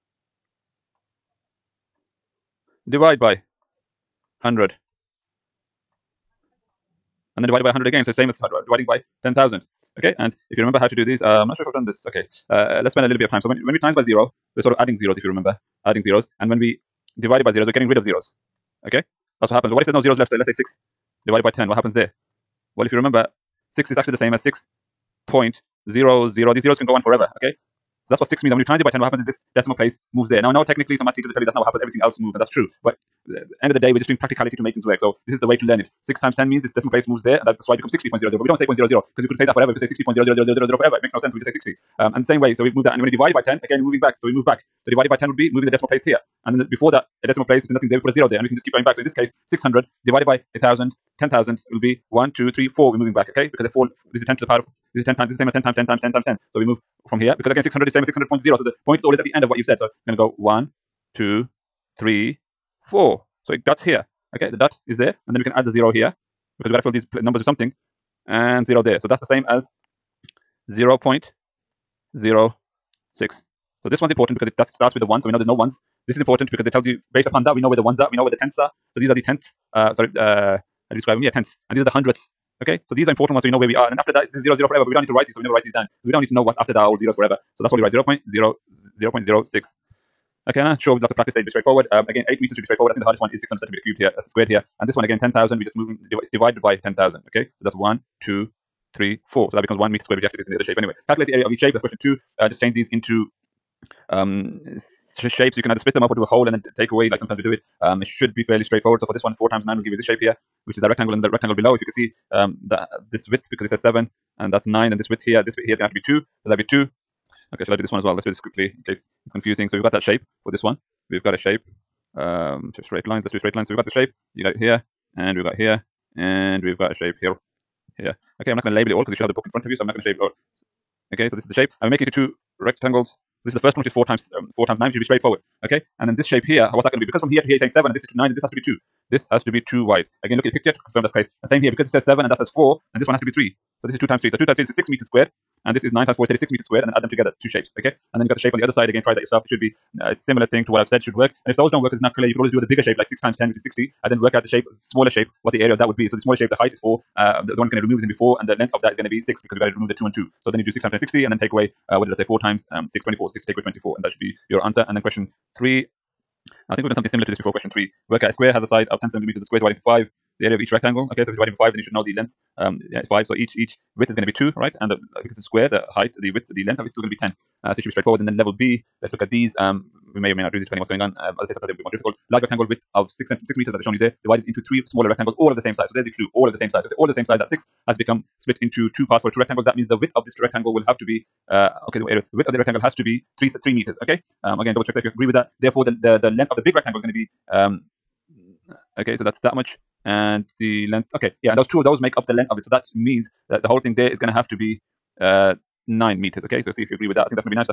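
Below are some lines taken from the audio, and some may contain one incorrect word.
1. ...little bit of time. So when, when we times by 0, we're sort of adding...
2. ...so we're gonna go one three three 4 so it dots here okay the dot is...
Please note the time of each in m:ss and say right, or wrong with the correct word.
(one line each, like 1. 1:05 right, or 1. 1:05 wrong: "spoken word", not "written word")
1. 0:13 right
2. 0:59 wrong: "two", not "three".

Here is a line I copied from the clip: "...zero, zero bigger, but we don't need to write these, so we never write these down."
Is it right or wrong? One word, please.
wrong.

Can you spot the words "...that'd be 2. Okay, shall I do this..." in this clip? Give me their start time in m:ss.
1:56.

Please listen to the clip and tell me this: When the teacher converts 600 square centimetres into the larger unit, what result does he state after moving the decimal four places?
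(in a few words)
1 meter squared.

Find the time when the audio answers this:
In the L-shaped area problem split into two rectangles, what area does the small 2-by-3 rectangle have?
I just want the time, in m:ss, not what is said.
2:24.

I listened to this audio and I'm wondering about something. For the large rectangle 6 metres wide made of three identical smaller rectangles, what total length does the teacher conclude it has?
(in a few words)
9 meters.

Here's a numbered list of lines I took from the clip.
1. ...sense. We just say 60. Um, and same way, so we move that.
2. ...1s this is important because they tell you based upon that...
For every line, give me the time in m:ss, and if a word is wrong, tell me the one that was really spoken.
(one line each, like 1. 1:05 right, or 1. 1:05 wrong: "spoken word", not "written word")
1. 0:41 right
2. 1:15 right.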